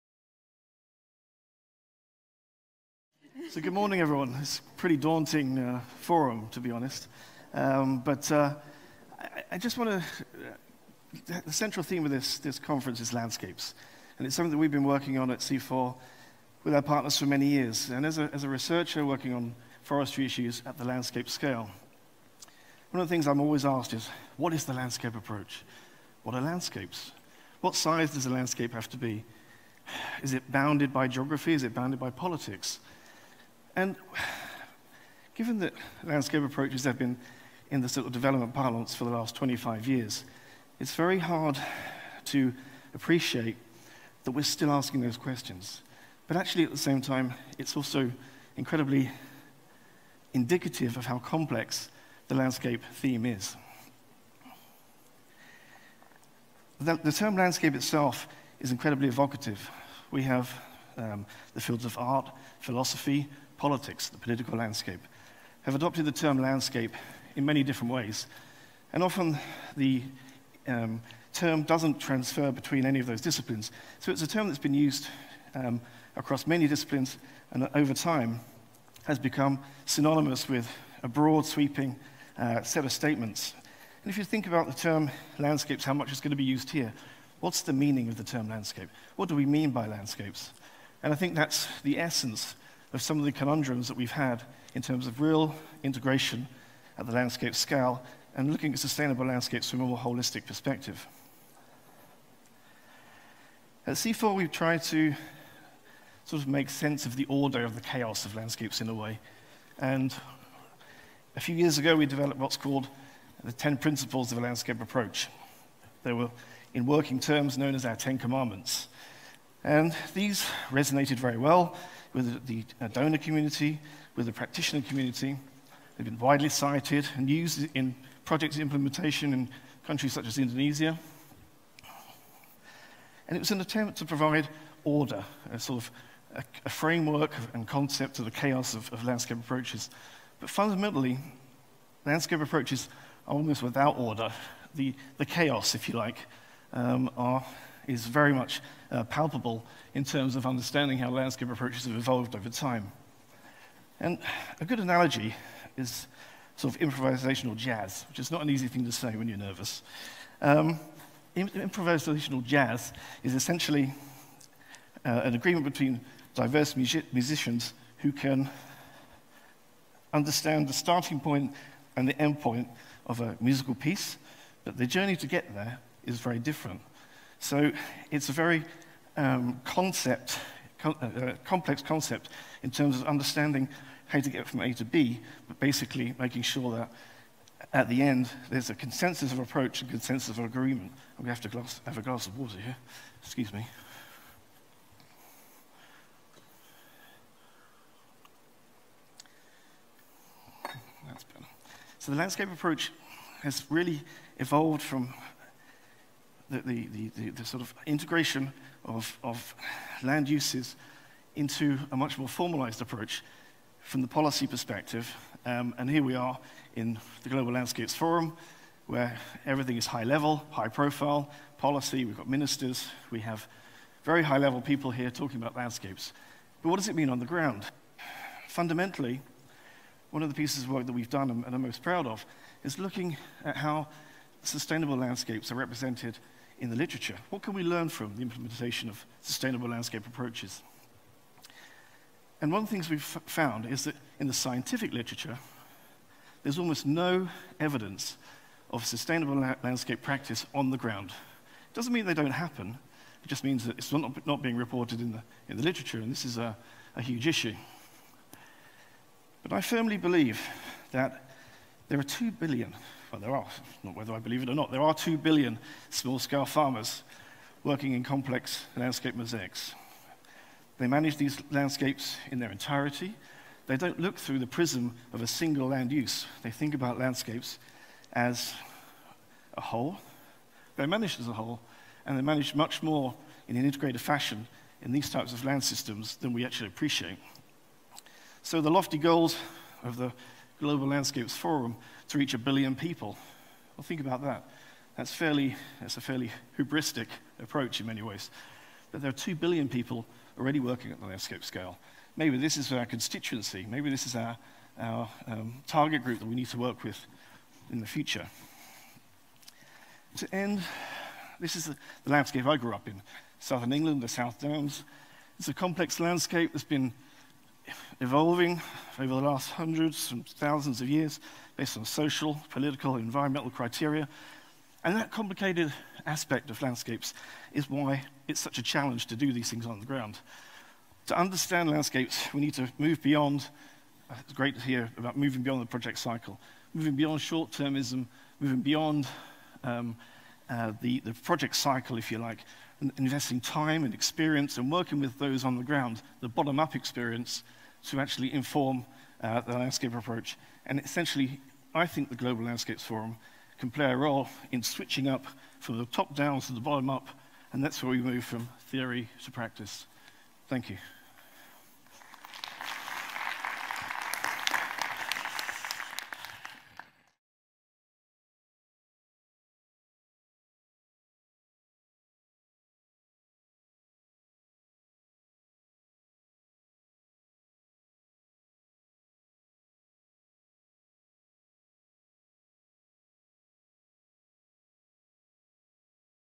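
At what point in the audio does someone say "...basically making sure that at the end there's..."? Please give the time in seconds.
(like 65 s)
185 s.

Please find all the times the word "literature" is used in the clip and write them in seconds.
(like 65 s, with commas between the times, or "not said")
236 s, 244 s, 255 s.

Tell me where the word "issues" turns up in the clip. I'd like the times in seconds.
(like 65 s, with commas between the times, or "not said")
20 s, 257 s.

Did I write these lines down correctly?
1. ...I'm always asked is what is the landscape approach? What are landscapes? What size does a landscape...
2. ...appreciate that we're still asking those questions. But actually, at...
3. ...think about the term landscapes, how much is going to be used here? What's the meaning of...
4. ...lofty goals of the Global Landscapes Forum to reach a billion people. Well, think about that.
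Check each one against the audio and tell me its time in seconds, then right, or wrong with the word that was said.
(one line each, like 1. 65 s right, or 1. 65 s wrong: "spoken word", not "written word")
1. 23 s right
2. 42 s right
3. 84 s right
4. 288 s right.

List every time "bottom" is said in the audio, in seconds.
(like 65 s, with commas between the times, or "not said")
346 s, 356 s.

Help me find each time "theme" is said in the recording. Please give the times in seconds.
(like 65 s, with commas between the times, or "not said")
11 s, 52 s.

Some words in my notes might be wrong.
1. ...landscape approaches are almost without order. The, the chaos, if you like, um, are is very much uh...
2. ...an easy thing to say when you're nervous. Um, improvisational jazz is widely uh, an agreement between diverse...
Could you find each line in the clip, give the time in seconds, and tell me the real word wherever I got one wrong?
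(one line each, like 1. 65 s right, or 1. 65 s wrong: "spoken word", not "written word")
1. 142 s right
2. 158 s wrong: "essentially", not "widely".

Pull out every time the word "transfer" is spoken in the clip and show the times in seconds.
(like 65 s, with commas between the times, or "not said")
71 s.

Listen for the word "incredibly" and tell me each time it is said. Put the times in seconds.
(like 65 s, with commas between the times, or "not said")
48 s, 58 s.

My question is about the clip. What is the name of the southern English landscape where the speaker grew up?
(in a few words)
South Downs.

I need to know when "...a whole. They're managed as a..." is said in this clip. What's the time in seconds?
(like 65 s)
279 s.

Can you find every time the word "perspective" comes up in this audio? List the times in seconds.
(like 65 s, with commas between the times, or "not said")
100 s, 214 s.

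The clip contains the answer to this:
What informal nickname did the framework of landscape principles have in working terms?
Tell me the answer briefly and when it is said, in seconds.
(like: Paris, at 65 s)
10 commandments, at 117 s.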